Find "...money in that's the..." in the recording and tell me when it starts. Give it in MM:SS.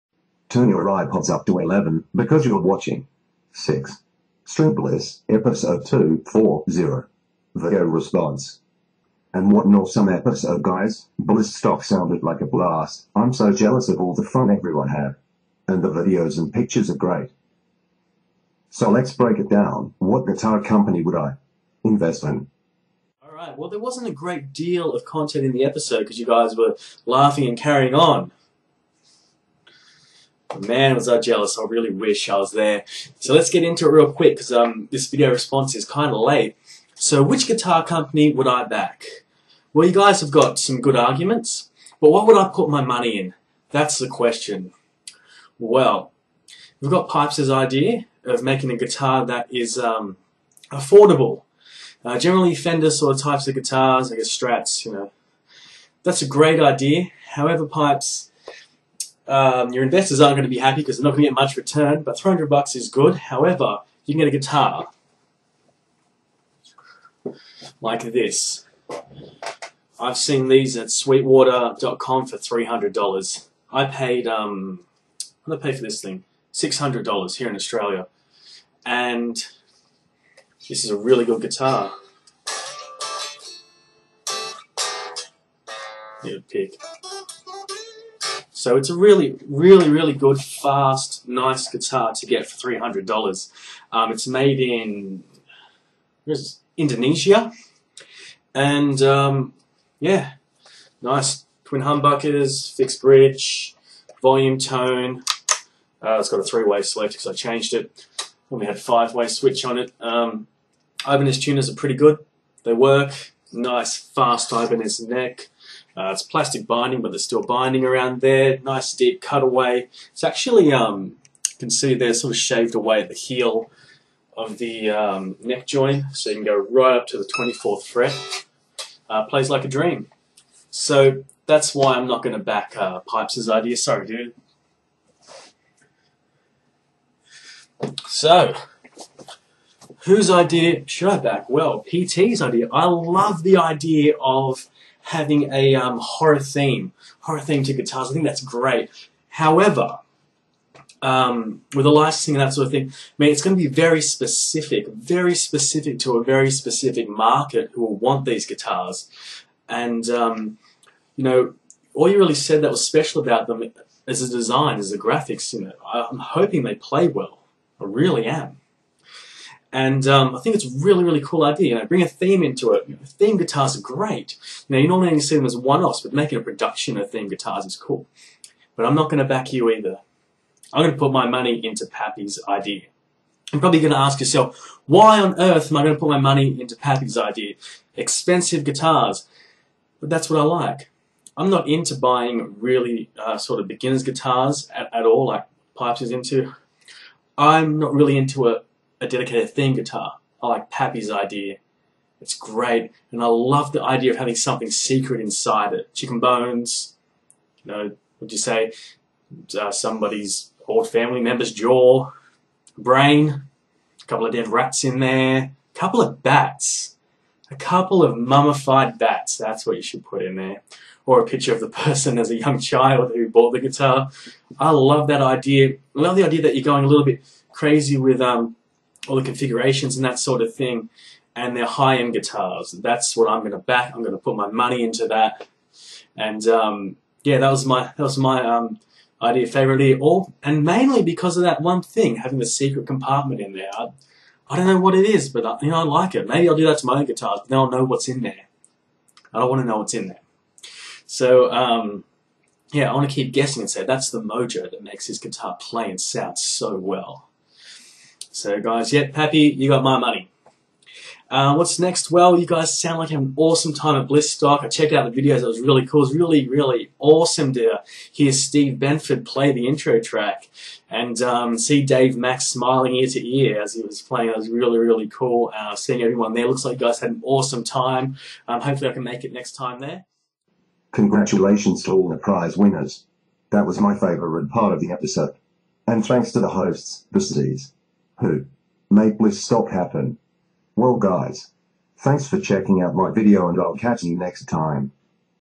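00:42.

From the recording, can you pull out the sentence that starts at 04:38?
Um, hopefully I can make it next time there.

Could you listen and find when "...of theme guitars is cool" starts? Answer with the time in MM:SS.
02:56.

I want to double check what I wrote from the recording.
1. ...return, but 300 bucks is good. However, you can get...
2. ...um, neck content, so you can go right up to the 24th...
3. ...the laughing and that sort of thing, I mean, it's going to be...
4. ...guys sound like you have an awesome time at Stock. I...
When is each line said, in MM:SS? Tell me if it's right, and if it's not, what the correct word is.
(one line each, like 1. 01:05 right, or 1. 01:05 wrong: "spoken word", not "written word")
1. 01:01 right
2. 02:04 wrong: "joint", not "content"
3. 02:31 wrong: "licensing", not "laughing"
4. 04:22 right.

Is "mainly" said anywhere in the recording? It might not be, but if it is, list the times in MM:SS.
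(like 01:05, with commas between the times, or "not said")
04:00.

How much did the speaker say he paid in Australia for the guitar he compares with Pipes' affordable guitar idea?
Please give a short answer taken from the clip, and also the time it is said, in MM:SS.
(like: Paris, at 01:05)
$600, at 01:16.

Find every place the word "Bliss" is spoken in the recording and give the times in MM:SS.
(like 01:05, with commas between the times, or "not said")
00:04, 00:11.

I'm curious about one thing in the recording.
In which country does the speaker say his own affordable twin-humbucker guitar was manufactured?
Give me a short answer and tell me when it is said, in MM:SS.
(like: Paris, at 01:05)
Indonesia, at 01:36.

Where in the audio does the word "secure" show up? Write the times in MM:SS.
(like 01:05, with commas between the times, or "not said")
not said.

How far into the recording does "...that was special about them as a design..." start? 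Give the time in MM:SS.
02:42.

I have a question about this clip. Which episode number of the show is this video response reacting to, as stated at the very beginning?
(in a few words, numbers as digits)
240.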